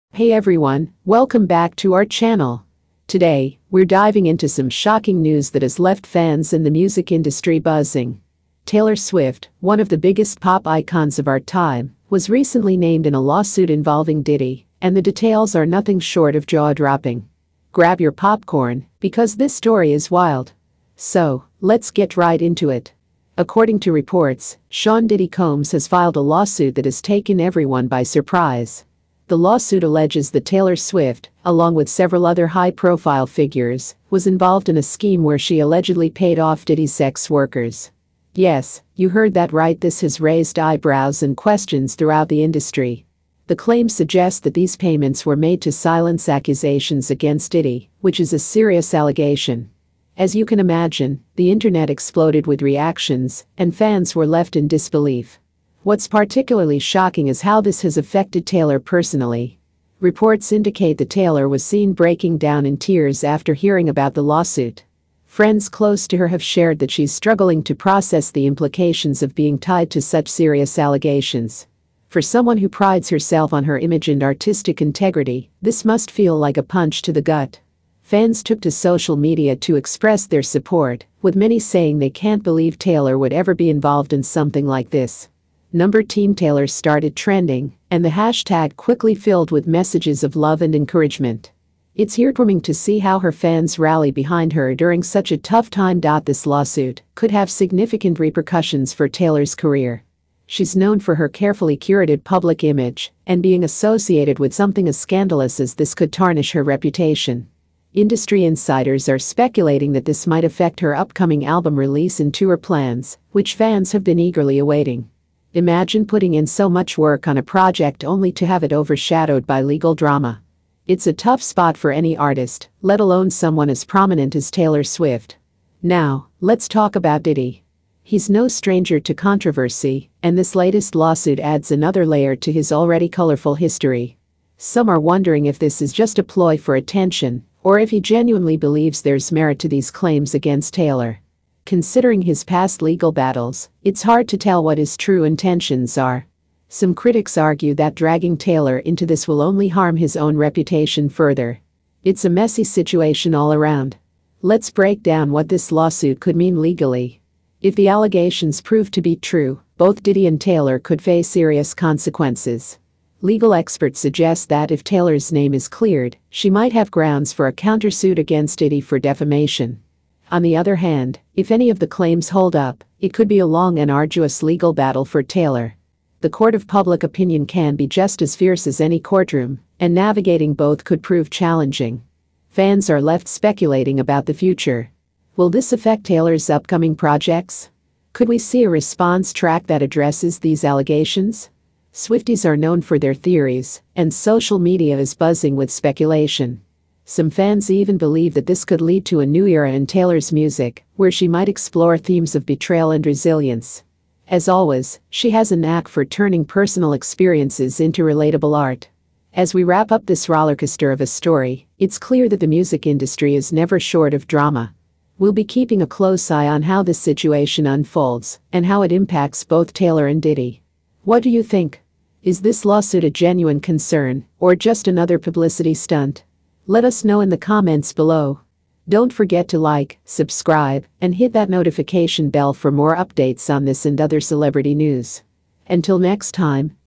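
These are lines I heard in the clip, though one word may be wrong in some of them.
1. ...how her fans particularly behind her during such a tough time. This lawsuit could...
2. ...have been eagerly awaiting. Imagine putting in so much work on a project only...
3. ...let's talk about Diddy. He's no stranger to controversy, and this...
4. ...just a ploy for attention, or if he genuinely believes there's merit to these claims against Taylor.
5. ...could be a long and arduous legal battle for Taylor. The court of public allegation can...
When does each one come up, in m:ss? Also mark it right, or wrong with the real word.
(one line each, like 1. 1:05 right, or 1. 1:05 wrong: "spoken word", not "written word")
1. 1:32 wrong: "rally", not "particularly"
2. 1:53 right
3. 2:06 right
4. 2:15 right
5. 2:53 wrong: "opinion", not "allegation".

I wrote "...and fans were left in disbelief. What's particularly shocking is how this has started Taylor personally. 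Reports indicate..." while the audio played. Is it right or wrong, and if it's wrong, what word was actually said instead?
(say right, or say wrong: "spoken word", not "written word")
wrong: "affected", not "started".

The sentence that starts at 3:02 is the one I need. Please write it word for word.
Fans are left speculating about the future.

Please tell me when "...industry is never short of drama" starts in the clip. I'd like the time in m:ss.
3:32.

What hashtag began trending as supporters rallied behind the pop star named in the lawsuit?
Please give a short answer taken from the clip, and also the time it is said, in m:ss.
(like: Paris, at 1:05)
Team Taylor, at 1:26.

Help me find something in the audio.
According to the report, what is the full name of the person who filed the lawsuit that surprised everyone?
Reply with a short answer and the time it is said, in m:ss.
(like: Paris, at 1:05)
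Sean Diddy Combs, at 0:24.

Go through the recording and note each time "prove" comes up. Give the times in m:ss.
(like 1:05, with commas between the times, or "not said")
2:38, 3:01.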